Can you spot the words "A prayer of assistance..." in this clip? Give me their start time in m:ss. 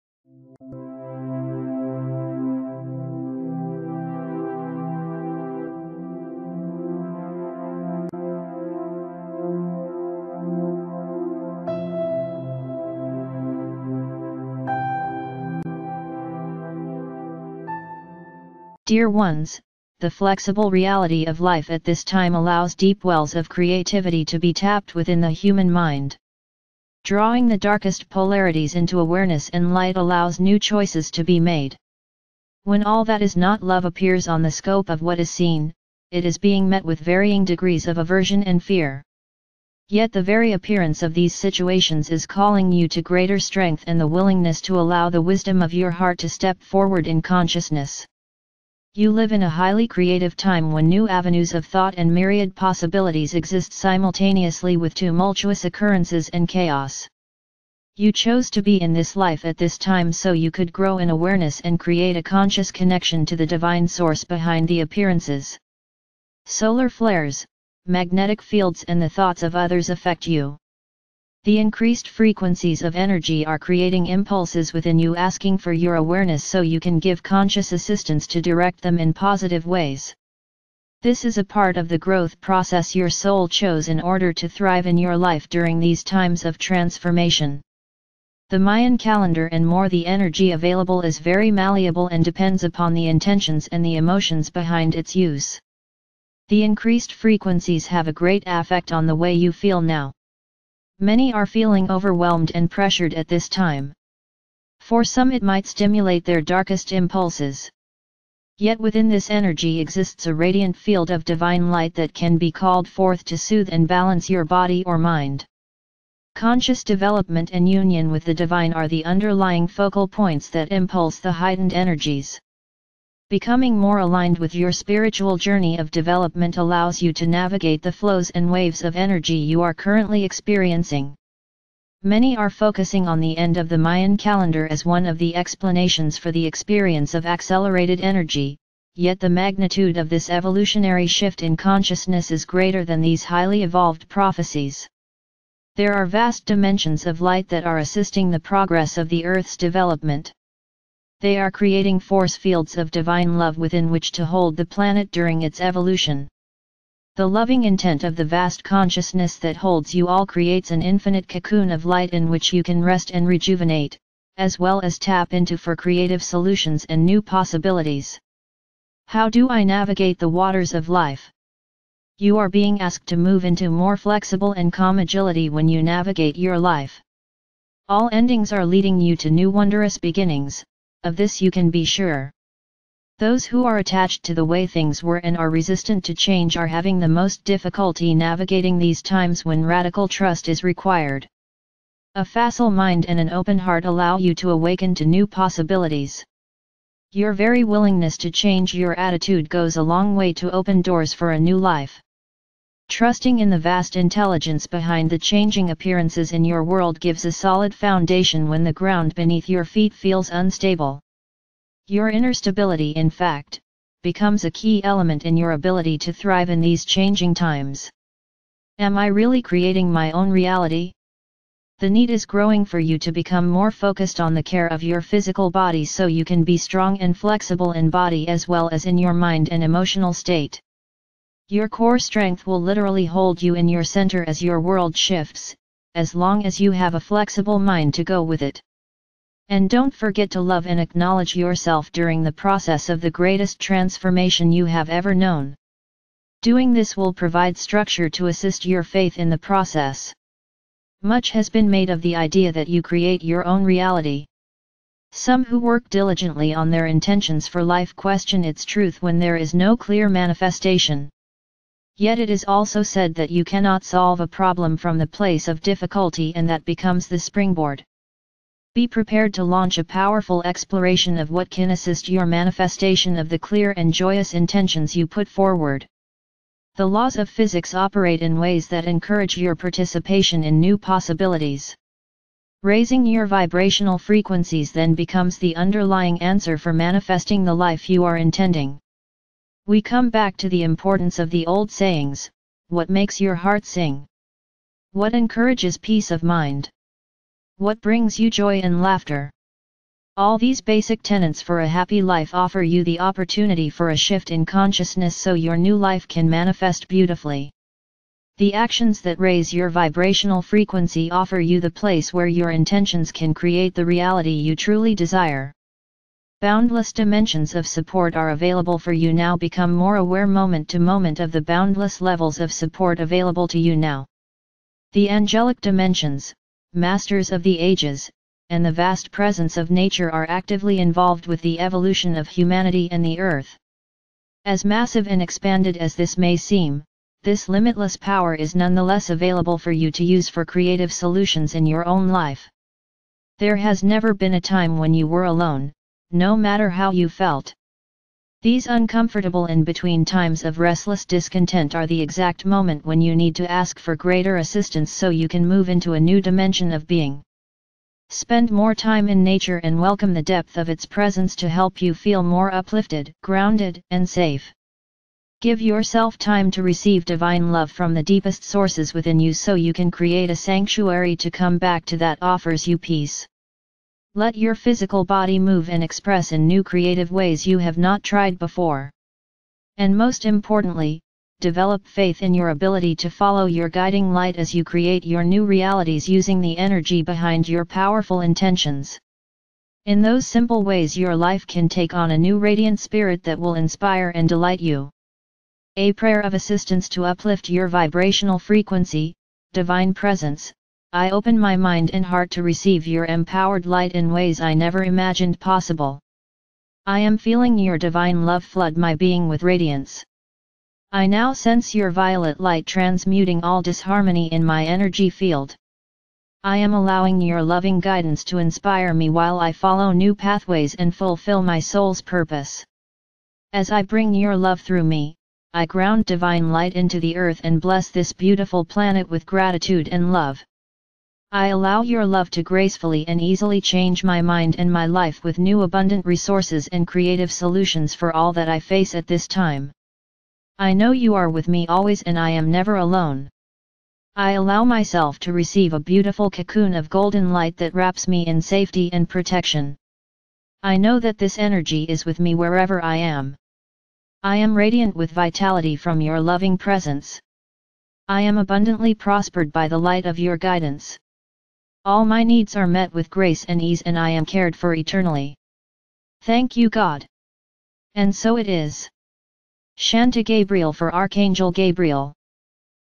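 6:35.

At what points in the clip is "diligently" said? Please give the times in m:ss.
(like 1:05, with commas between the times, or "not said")
4:15.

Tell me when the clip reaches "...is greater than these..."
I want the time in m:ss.
2:22.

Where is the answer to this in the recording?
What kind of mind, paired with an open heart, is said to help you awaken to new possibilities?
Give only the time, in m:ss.
3:12.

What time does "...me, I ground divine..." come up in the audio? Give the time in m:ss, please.
7:04.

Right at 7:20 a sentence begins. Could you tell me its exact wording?
I know you are with me always and I am never alone.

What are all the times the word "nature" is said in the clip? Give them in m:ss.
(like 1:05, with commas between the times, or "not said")
5:29, 5:59.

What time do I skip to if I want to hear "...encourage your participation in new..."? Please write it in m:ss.
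4:38.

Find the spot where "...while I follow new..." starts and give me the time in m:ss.
6:59.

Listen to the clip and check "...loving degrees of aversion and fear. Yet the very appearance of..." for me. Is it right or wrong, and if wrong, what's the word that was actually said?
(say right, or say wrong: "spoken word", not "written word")
wrong: "varying", not "loving".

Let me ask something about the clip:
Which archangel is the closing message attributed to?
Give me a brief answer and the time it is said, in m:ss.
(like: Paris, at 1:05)
Archangel Gabriel, at 7:50.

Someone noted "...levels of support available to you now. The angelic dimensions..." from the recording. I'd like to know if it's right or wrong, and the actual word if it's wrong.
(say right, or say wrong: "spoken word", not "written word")
right.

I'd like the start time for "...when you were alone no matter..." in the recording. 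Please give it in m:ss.
5:44.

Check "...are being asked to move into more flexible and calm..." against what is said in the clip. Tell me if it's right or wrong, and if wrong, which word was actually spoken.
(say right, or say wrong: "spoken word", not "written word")
right.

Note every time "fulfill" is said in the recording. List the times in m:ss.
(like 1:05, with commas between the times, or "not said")
7:00.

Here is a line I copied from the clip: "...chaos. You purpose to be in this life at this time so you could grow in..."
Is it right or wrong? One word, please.
wrong.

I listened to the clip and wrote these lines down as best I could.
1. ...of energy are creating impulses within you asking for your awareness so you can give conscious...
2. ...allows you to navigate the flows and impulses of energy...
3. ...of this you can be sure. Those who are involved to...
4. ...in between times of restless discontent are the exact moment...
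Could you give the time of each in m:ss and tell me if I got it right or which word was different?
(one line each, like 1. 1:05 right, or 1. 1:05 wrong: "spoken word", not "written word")
1. 1:12 right
2. 2:06 wrong: "waves", not "impulses"
3. 3:01 wrong: "attached", not "involved"
4. 5:49 right.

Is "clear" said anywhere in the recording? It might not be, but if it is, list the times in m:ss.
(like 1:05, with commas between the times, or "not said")
4:19, 4:33.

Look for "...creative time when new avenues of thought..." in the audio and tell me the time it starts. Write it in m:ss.
0:49.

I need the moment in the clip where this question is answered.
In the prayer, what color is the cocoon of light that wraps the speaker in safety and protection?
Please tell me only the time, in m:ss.
7:26.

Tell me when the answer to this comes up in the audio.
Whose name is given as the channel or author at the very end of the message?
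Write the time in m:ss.
7:49.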